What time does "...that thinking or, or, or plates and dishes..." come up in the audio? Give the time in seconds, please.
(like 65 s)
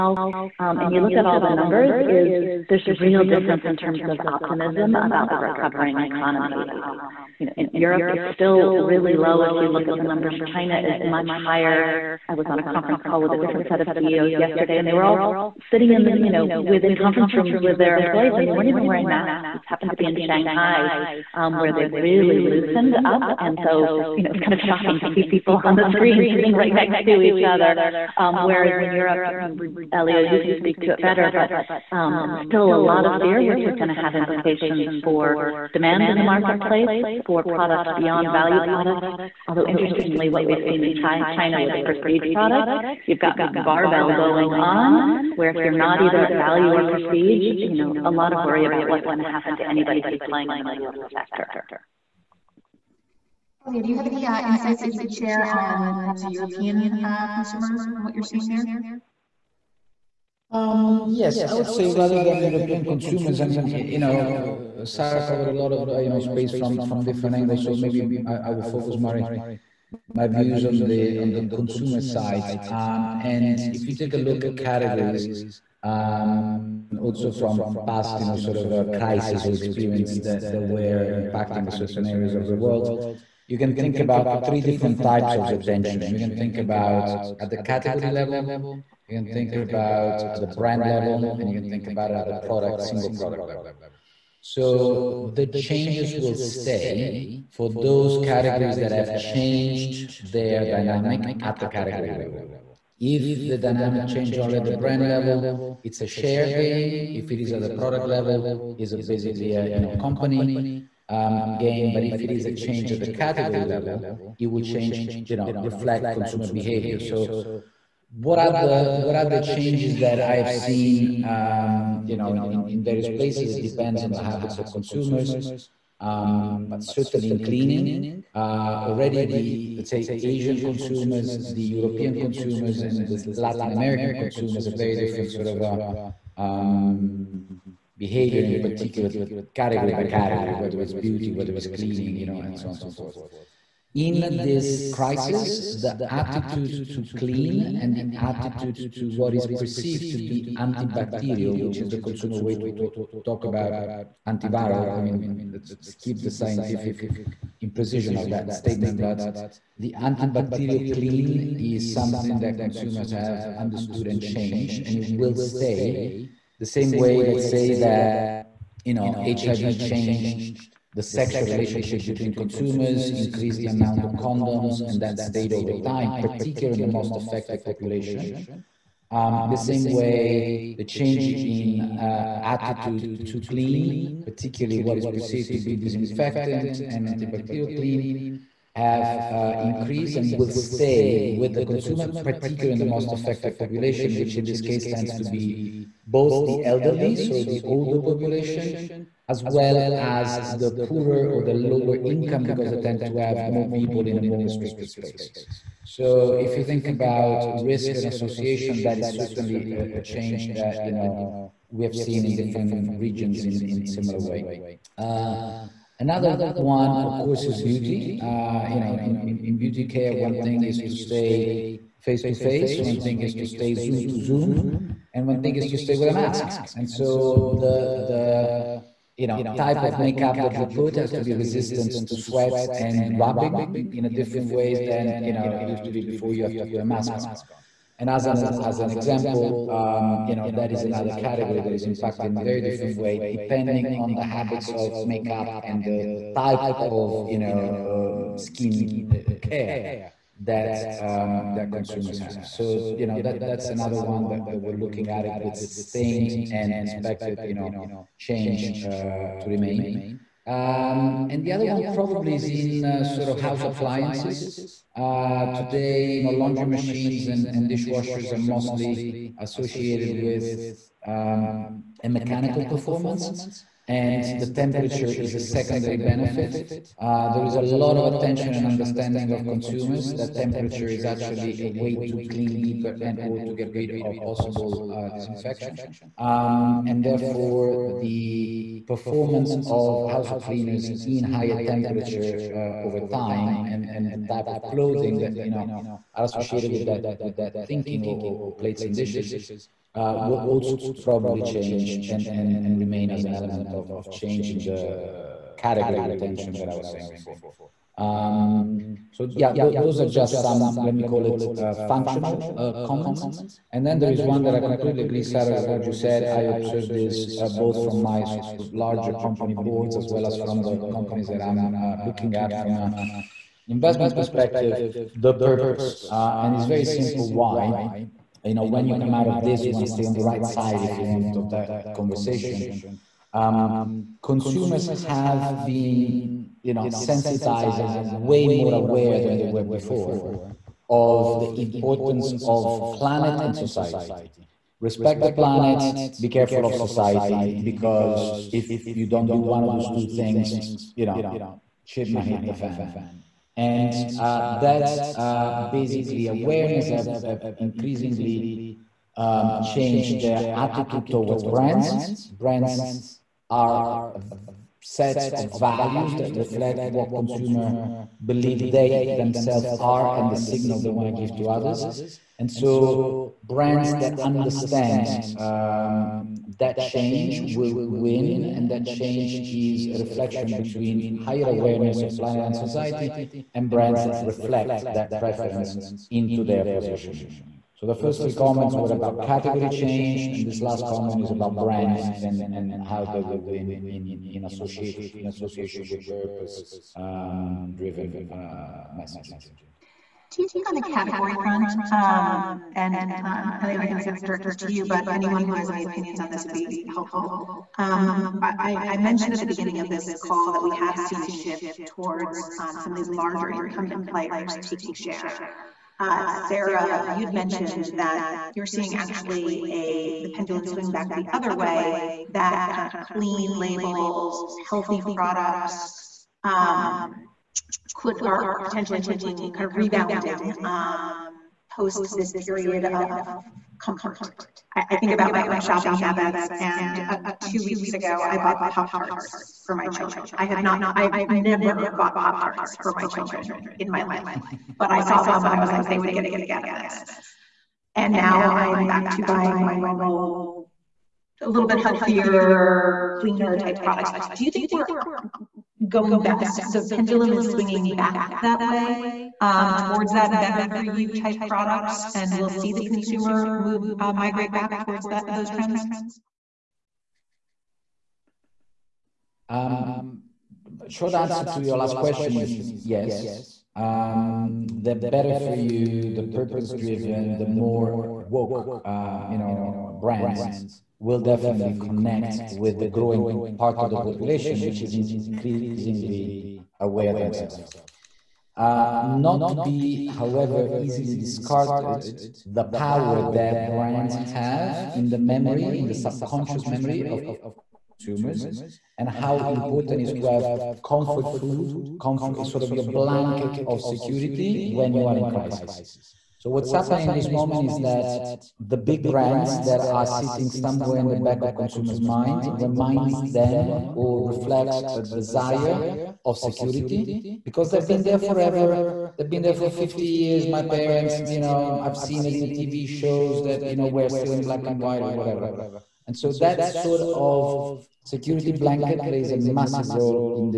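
297 s.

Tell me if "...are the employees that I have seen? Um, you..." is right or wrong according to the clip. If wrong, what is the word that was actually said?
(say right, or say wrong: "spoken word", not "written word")
wrong: "changes", not "employees".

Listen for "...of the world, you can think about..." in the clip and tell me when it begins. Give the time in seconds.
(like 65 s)
82 s.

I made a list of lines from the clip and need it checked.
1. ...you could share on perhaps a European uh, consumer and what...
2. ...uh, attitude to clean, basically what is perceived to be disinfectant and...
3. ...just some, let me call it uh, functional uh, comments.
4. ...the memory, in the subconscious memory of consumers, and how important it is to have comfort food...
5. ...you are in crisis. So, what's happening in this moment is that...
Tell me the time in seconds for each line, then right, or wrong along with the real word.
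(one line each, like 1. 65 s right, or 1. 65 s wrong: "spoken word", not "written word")
1. 54 s right
2. 181 s wrong: "particularly", not "basically"
3. 310 s right
4. 495 s right
5. 504 s right.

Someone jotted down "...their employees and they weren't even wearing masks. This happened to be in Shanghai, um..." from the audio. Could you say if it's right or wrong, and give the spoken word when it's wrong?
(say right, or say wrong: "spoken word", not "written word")
right.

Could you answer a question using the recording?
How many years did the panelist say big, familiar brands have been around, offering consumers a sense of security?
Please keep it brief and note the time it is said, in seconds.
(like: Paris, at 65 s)
50, at 519 s.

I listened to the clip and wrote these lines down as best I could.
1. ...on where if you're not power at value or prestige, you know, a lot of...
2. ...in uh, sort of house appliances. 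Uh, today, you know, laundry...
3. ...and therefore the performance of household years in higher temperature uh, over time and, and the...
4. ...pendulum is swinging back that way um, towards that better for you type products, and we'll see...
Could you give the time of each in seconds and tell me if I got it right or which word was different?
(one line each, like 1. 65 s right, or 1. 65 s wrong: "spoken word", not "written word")
1. 44 s wrong: "either", not "power"
2. 262 s right
3. 286 s wrong: "cleaners", not "years"
4. 456 s right.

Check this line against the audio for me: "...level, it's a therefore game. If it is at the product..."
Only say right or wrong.
wrong.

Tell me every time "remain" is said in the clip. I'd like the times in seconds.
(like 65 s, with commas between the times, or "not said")
259 s, 302 s.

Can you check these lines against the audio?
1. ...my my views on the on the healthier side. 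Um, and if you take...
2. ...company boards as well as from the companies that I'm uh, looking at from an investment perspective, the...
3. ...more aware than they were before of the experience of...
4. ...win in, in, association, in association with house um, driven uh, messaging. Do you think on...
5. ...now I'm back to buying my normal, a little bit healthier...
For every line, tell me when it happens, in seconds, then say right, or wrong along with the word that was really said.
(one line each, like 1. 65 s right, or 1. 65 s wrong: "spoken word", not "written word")
1. 68 s wrong: "consumer", not "healthier"
2. 319 s right
3. 338 s wrong: "importance", not "experience"
4. 393 s wrong: "purpose", not "house"
5. 448 s right.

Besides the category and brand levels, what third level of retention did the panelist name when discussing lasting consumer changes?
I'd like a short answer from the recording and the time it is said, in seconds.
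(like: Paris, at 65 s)
Single product level, at 92 s.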